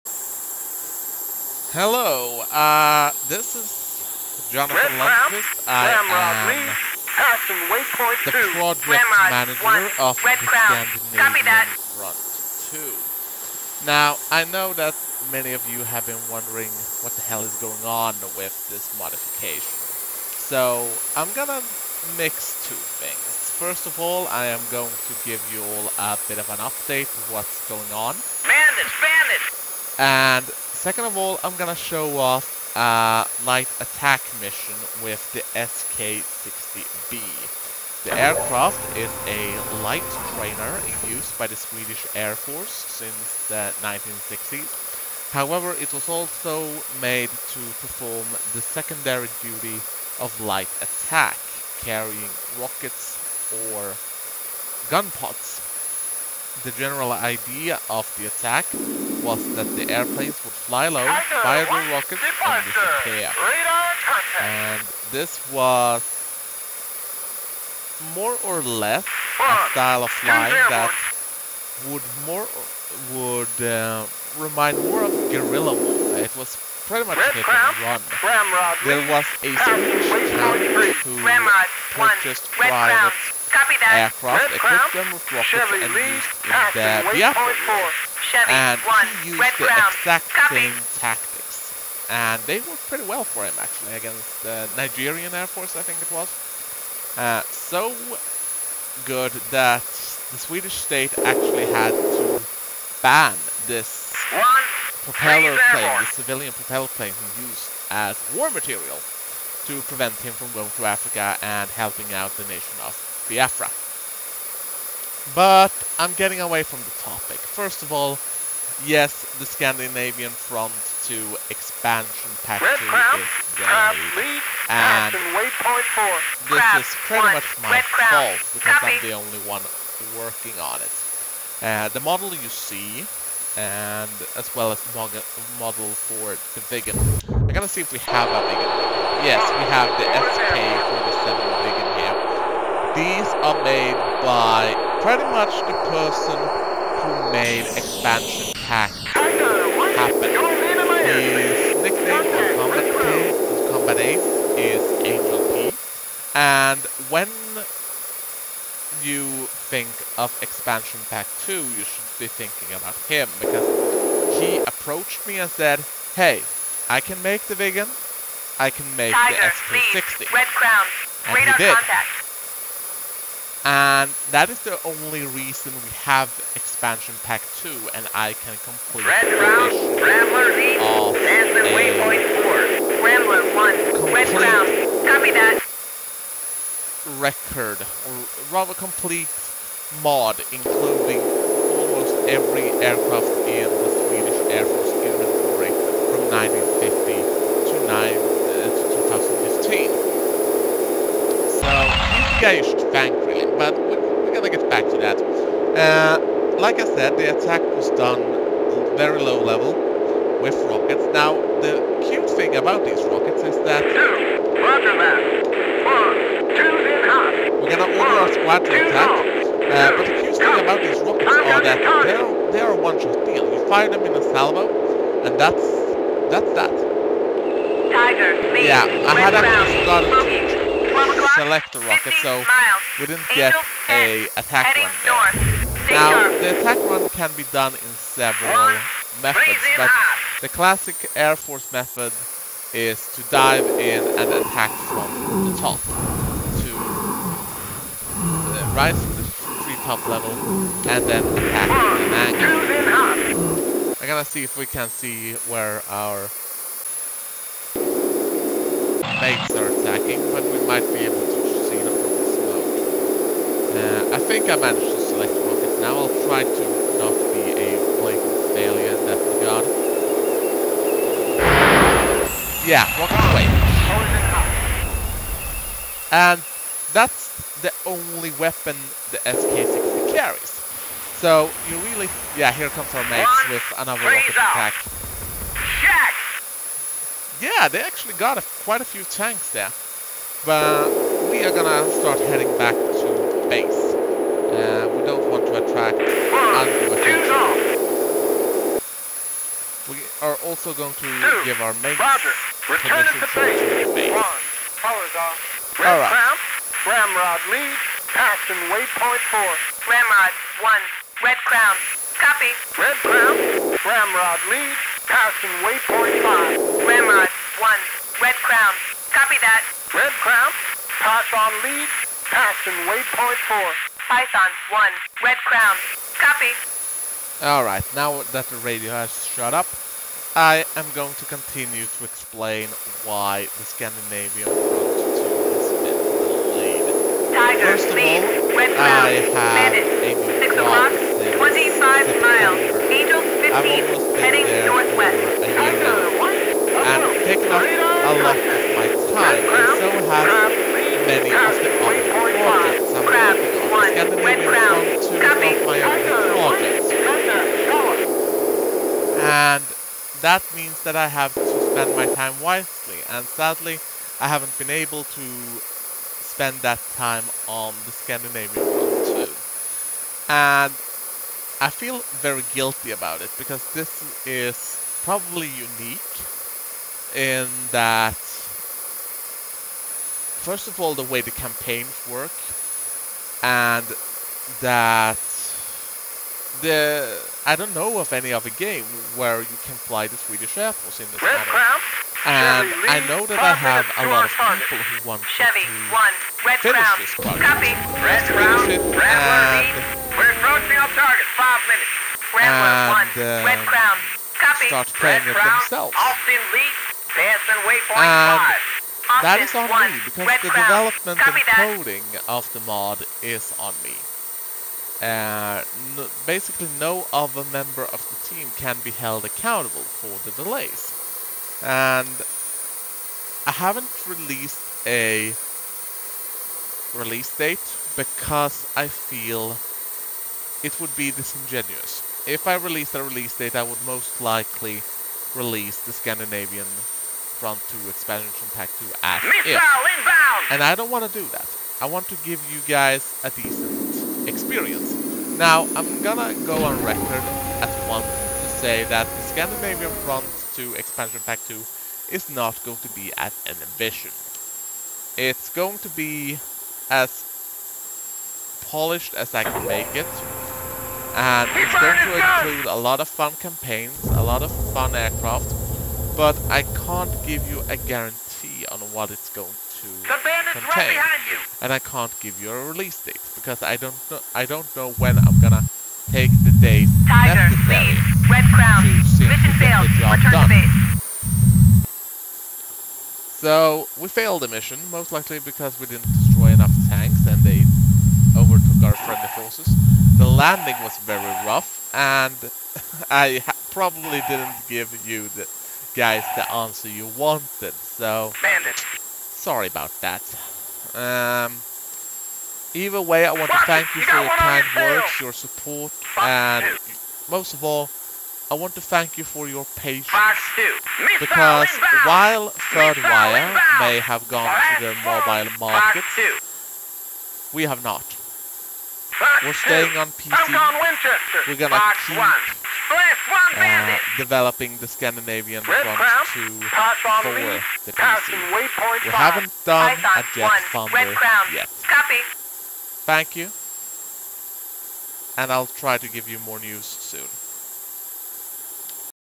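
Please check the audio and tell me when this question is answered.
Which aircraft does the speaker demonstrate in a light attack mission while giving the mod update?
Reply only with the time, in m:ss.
0:35.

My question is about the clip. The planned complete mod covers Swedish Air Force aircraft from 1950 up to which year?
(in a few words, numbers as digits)
2015.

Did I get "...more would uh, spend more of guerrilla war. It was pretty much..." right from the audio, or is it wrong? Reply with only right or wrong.
wrong.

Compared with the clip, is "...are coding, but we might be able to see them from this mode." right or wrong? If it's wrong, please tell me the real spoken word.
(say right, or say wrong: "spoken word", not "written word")
wrong: "attacking", not "coding".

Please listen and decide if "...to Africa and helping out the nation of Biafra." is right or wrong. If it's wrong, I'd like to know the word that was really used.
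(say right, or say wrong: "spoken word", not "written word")
right.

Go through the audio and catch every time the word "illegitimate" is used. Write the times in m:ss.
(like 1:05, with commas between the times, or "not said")
not said.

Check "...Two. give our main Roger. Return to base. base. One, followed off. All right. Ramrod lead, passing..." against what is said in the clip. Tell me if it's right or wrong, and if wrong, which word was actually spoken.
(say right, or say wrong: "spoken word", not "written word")
right.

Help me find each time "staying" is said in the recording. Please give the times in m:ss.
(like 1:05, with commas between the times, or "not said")
8:39.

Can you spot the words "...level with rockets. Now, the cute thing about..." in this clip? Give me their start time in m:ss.
3:29.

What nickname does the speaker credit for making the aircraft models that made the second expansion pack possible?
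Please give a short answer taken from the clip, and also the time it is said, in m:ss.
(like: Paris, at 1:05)
Angel P, at 2:35.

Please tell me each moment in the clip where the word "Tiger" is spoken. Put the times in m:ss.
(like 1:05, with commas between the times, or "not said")
2:49, 3:47, 5:37, 7:57.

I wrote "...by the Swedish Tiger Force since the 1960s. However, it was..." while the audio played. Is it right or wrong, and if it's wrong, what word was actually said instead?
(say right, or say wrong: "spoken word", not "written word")
wrong: "Air", not "Tiger".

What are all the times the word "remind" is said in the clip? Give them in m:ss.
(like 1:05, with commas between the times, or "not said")
1:14.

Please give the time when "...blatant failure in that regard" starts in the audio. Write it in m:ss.
4:28.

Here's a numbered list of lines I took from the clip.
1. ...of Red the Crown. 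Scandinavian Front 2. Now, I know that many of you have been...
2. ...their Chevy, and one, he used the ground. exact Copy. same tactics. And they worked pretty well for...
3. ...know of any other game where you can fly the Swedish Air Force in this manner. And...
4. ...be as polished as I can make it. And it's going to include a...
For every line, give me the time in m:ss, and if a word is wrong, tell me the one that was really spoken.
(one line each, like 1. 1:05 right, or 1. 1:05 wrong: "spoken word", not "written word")
1. 0:09 right
2. 1:26 right
3. 6:27 right
4. 7:35 right.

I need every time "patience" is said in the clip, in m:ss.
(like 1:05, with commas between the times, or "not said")
8:29.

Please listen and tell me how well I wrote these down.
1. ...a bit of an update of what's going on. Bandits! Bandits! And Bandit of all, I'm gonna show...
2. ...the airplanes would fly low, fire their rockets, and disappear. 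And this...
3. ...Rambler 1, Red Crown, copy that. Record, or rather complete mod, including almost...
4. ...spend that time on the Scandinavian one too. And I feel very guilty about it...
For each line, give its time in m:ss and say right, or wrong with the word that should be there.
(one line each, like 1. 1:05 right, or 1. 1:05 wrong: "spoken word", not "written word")
1. 0:25 wrong: "Second", not "Bandit"
2. 0:59 right
3. 3:03 right
4. 6:06 right.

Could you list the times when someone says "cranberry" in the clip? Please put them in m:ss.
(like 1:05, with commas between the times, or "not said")
not said.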